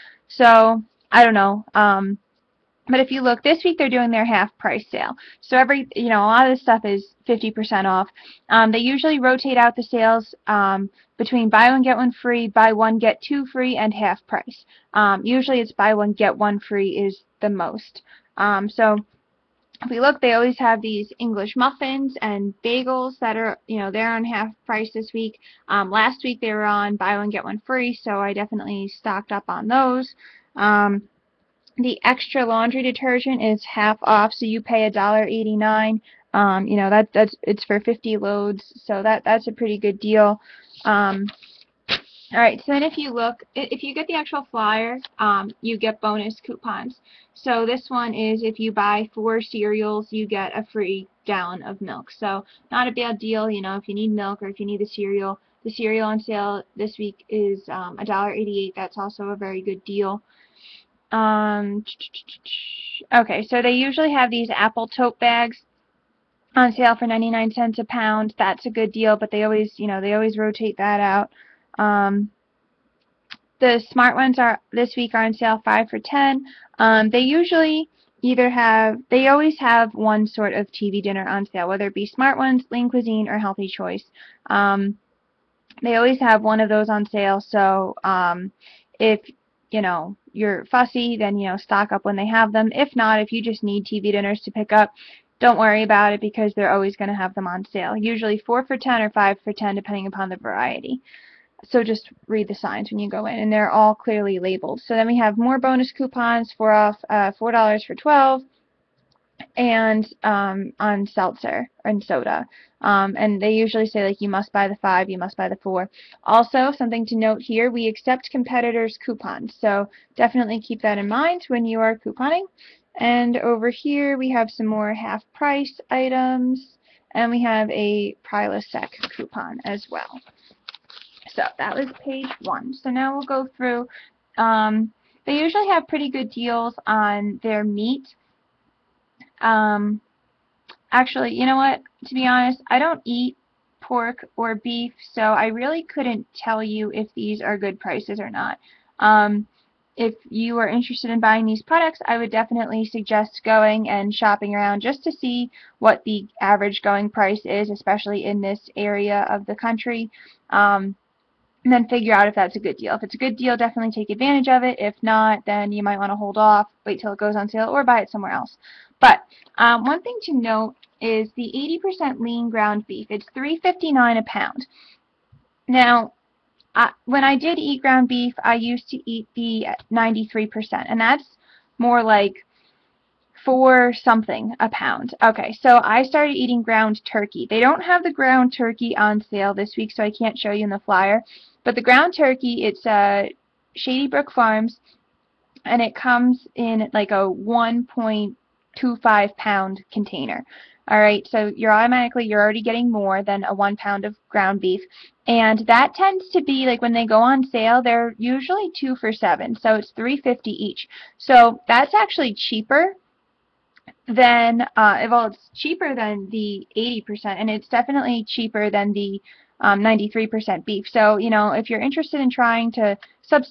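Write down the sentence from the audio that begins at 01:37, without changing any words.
Usually four for ten or five for ten, depending upon the variety.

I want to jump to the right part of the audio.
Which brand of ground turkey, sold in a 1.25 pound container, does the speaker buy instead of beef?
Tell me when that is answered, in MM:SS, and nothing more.
03:13.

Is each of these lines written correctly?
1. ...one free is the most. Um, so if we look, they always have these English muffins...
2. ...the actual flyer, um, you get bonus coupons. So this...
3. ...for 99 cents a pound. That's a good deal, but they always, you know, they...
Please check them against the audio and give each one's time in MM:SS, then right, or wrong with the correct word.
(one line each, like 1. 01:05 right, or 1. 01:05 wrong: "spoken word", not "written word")
1. 00:16 right
2. 00:44 right
3. 01:06 right.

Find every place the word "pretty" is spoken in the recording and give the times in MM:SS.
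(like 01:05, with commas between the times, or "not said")
00:39, 02:15.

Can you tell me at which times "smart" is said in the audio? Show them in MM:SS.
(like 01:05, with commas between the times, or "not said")
01:13, 01:22.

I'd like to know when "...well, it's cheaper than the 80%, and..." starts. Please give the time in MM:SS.
03:35.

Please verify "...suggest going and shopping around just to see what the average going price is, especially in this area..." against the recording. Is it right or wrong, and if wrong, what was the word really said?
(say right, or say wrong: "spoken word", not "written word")
right.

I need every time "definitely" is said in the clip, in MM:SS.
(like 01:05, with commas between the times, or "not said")
00:28, 02:00, 02:32, 02:43, 03:37.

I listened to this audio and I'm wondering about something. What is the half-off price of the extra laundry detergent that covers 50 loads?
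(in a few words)
$1.89.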